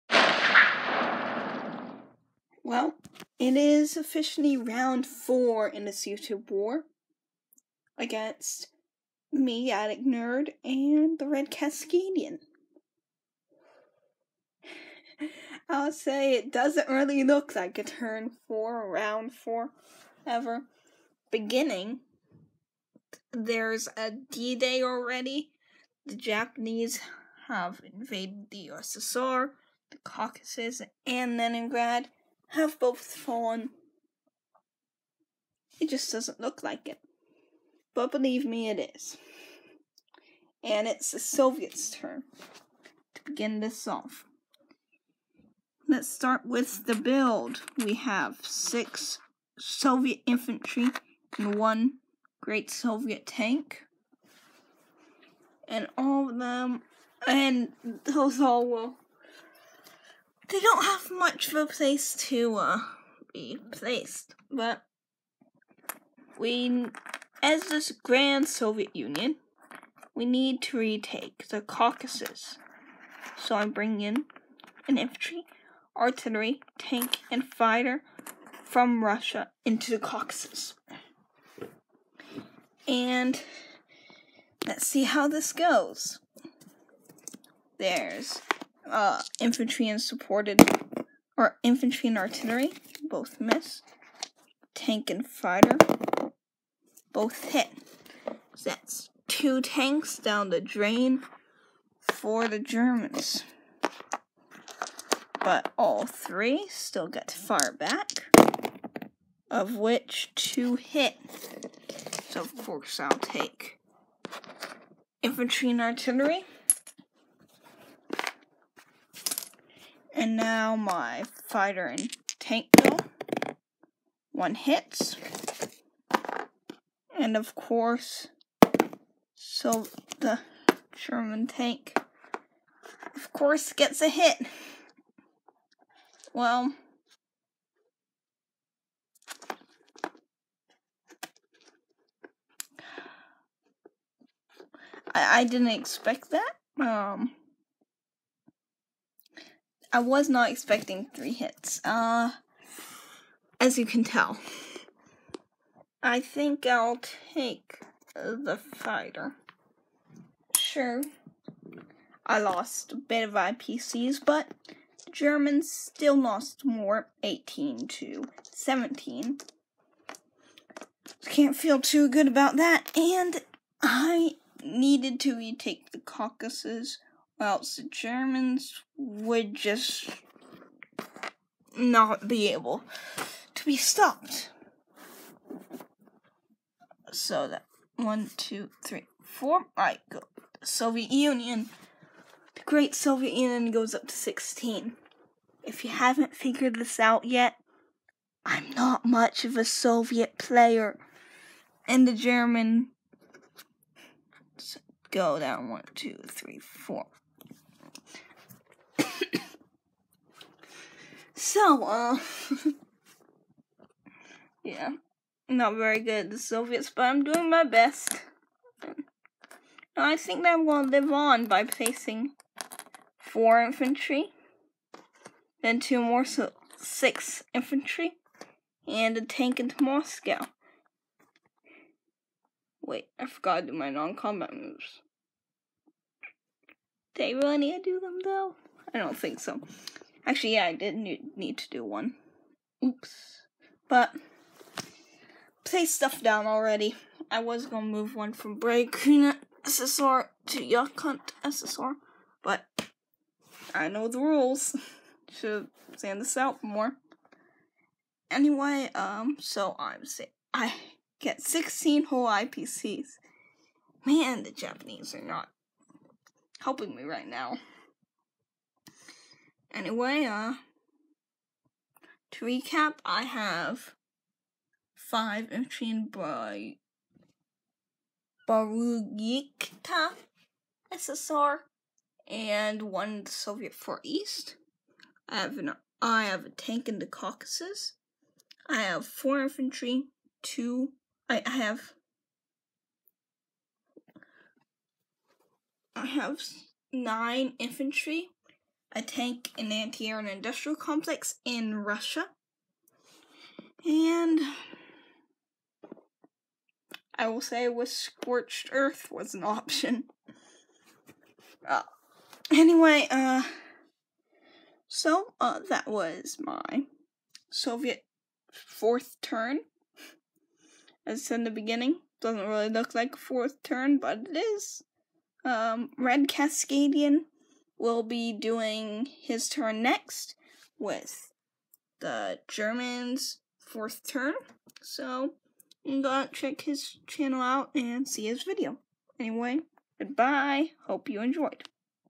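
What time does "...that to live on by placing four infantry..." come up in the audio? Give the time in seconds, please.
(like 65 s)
220 s.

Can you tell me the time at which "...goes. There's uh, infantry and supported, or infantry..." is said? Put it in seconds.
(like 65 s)
85 s.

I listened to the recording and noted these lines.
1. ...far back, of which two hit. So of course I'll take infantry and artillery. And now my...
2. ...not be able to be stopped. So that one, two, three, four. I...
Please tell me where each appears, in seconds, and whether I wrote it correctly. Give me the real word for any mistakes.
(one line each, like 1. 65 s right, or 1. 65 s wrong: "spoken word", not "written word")
1. 107 s right
2. 181 s right.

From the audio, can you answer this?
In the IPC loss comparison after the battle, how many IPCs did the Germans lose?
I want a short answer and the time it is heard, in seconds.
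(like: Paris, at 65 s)
18, at 167 s.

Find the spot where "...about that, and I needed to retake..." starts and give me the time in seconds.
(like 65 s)
172 s.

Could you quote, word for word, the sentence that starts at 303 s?
And I will say with scorched earth was an option.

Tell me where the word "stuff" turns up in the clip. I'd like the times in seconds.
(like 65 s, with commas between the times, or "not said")
245 s.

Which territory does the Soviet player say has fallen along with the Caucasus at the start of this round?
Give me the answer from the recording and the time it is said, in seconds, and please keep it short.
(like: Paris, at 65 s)
Leningrad, at 31 s.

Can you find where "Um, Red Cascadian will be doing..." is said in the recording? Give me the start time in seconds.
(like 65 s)
325 s.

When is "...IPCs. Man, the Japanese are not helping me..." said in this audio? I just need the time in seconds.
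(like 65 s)
262 s.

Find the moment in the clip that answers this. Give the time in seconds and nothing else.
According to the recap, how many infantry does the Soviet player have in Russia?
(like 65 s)
296 s.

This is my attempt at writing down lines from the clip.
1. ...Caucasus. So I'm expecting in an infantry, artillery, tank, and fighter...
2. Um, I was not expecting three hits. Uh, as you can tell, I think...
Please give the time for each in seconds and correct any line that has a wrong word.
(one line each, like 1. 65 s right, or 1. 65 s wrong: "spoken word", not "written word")
1. 71 s wrong: "bringing", not "expecting"
2. 146 s right.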